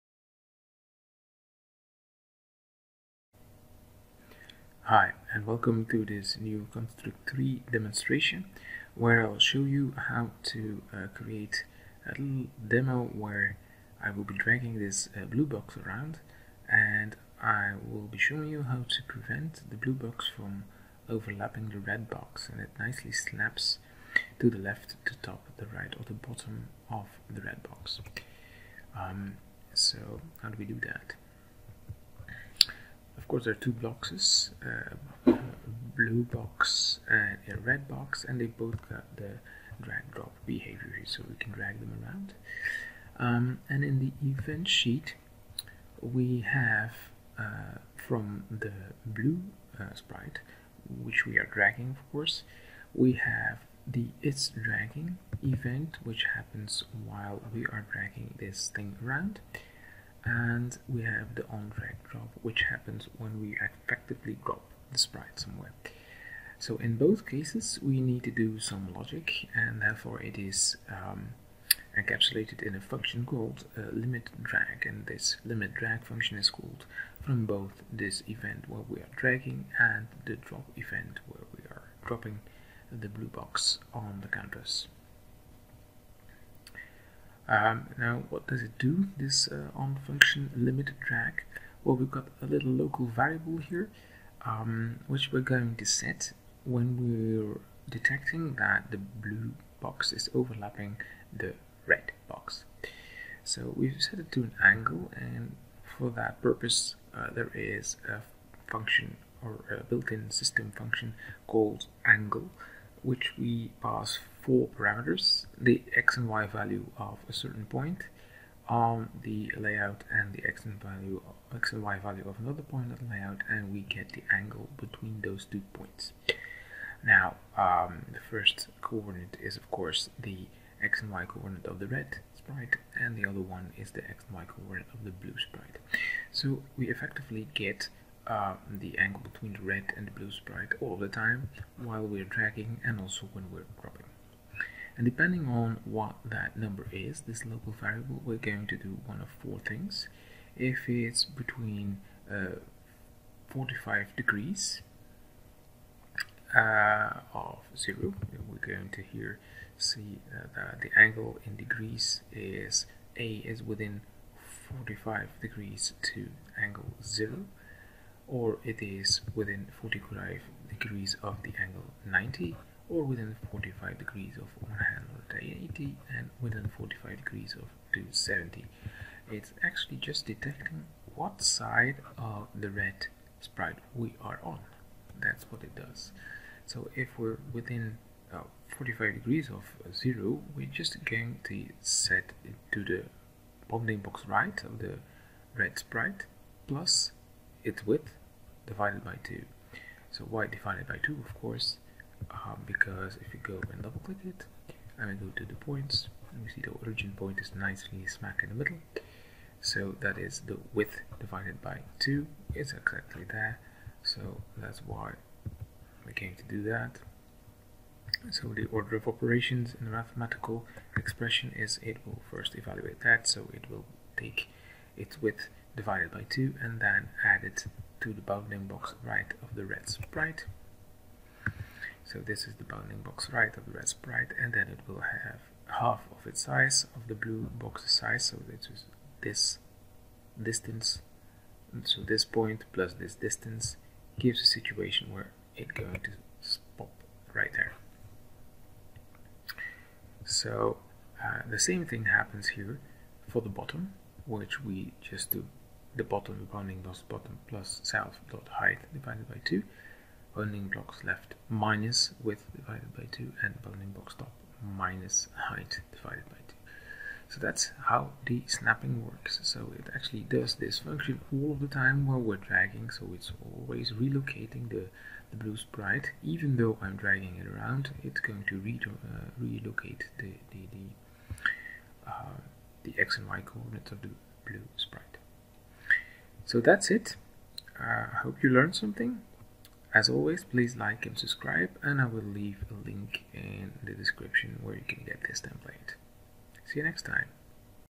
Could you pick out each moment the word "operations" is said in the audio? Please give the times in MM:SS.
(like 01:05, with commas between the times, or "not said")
03:39.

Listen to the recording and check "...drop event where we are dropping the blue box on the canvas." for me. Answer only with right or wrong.
right.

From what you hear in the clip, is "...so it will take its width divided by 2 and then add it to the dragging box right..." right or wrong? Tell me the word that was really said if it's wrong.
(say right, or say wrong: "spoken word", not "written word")
wrong: "bounding", not "dragging".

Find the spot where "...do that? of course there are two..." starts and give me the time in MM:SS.
00:30.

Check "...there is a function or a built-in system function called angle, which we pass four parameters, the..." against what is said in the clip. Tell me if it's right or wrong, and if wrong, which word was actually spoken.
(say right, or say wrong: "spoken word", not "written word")
right.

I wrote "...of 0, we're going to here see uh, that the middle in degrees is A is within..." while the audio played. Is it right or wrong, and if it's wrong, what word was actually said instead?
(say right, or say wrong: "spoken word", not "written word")
wrong: "angle", not "middle".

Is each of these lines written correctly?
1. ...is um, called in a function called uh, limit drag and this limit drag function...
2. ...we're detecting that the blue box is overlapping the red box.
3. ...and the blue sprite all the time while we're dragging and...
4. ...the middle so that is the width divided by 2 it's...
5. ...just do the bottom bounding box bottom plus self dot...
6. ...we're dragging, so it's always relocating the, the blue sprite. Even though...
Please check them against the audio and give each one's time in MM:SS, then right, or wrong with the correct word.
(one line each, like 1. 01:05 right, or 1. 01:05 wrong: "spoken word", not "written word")
1. 01:10 wrong: "encapsulated", not "called"
2. 01:36 right
3. 02:19 right
4. 03:28 right
5. 04:15 right
6. 04:32 right.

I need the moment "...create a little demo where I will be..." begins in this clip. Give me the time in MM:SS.
00:11.